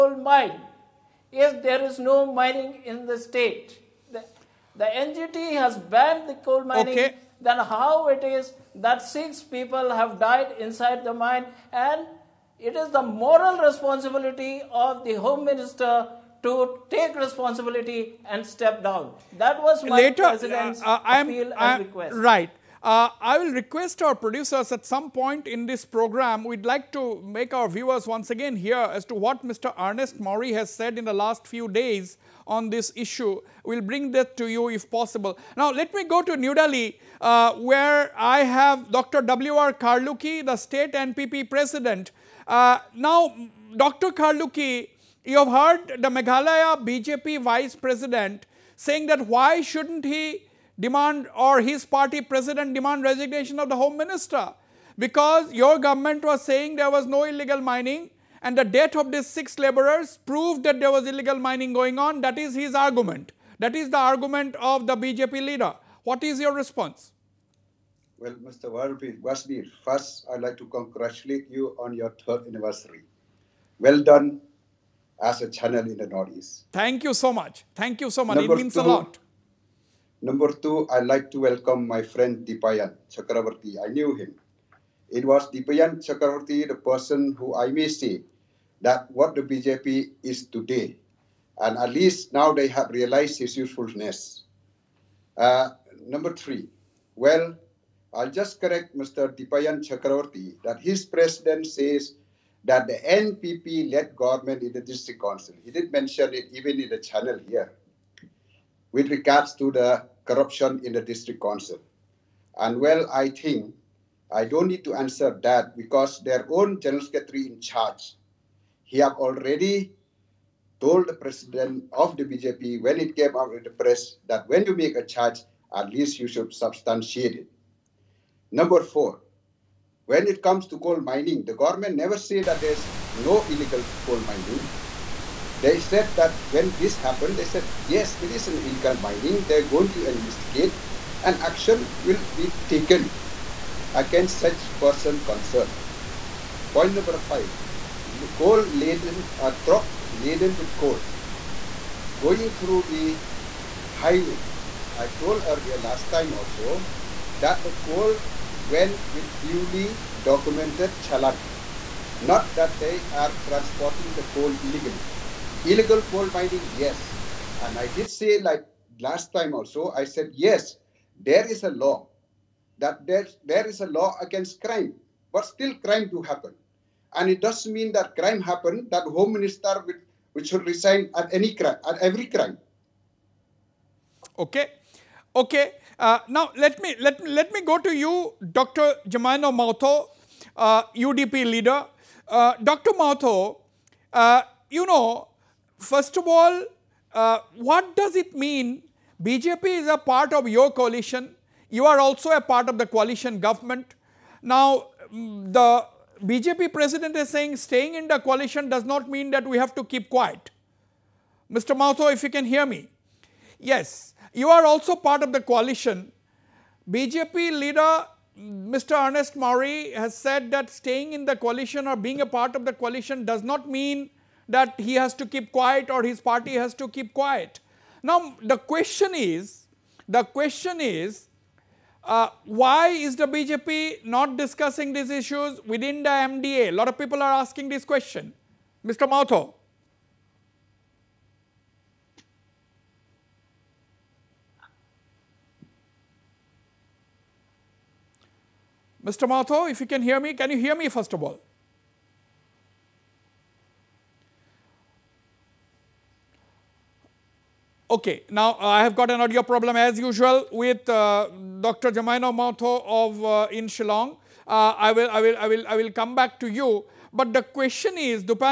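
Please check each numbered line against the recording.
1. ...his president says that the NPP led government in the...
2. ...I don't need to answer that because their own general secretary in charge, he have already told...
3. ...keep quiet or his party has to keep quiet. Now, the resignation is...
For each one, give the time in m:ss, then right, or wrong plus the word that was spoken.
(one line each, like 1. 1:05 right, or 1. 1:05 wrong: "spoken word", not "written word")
1. 1:40 right
2. 1:54 right
3. 3:45 wrong: "question", not "resignation".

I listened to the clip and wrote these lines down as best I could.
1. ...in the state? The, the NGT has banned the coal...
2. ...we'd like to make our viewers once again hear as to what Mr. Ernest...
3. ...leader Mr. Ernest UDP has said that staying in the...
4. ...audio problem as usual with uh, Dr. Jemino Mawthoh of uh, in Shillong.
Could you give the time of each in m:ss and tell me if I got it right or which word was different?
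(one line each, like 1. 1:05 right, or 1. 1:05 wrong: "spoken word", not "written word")
1. 0:02 right
2. 0:26 right
3. 3:37 wrong: "Mawrie", not "UDP"
4. 4:19 right.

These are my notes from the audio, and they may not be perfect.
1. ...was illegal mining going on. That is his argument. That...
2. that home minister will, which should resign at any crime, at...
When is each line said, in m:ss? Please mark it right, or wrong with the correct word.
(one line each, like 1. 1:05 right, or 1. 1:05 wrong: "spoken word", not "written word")
1. 1:00 right
2. 2:58 right.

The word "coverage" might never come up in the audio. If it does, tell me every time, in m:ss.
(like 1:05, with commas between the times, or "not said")
not said.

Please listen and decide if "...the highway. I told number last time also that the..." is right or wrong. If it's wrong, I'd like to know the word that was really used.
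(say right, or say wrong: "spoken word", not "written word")
wrong: "earlier", not "number".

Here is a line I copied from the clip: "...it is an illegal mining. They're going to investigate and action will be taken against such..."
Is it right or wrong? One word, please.
right.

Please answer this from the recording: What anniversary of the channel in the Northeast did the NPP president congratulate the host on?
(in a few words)
Third.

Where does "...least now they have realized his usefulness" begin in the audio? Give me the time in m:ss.
1:31.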